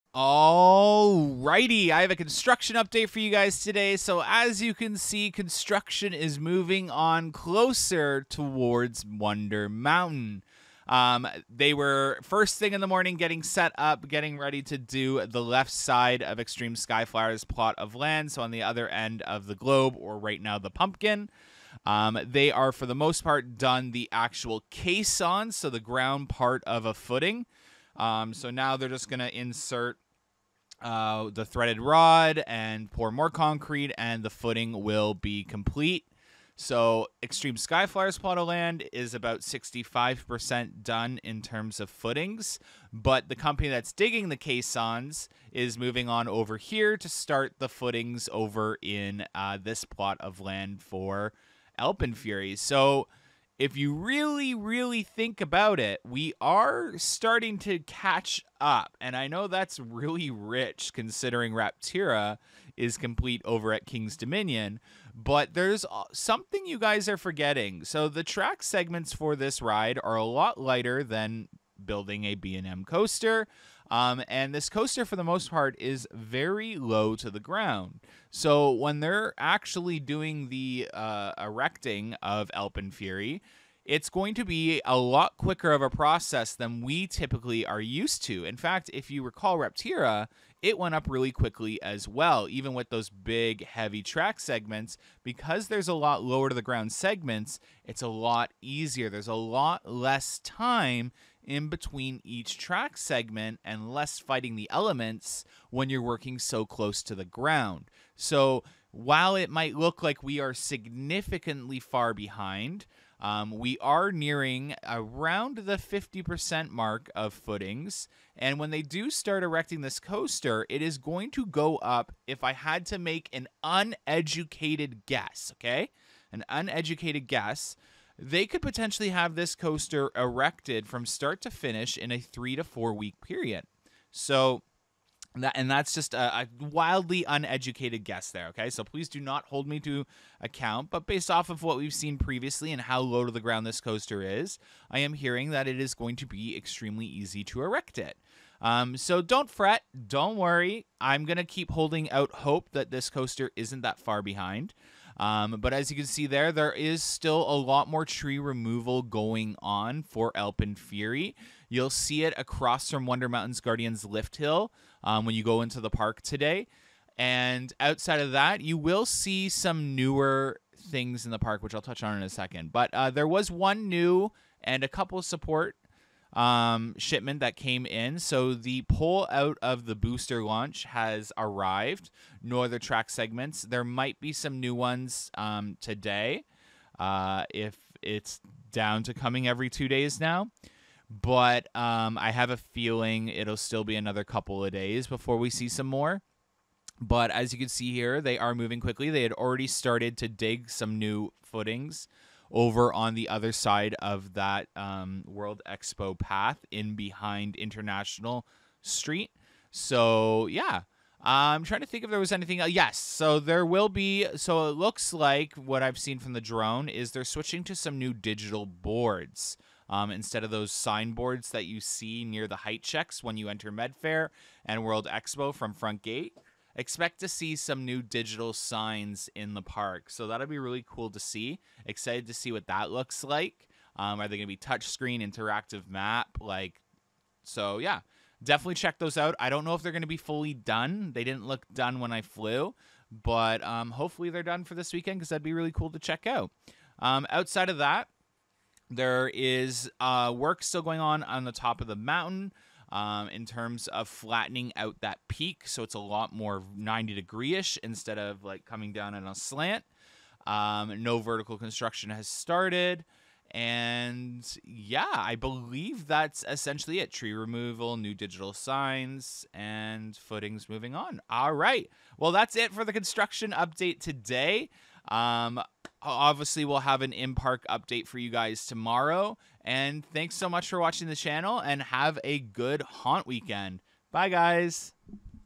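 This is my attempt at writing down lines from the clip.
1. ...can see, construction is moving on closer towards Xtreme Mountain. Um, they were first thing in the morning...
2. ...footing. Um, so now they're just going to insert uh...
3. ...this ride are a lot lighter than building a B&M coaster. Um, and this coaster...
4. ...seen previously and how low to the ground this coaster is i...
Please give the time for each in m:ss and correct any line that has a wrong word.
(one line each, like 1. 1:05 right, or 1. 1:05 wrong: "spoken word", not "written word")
1. 0:04 wrong: "Wonder", not "Xtreme"
2. 0:26 right
3. 1:09 right
4. 2:21 right.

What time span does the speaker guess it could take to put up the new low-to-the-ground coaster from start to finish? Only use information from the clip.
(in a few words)
3 to 4 weeks.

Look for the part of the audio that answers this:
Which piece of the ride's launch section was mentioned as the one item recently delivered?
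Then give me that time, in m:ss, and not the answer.
2:58.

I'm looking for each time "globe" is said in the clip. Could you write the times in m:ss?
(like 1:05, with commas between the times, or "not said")
0:19.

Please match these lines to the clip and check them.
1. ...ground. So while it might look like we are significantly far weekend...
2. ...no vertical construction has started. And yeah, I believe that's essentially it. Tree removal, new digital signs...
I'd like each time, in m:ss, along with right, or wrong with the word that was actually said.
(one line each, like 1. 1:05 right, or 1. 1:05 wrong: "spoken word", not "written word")
1. 1:47 wrong: "behind", not "weekend"
2. 4:21 right.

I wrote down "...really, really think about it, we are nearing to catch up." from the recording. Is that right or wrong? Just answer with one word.
wrong.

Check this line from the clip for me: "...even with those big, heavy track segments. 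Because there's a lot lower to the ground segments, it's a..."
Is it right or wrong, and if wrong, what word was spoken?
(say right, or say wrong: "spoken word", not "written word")
right.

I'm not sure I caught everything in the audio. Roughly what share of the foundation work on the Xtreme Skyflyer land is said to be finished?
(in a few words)
65%.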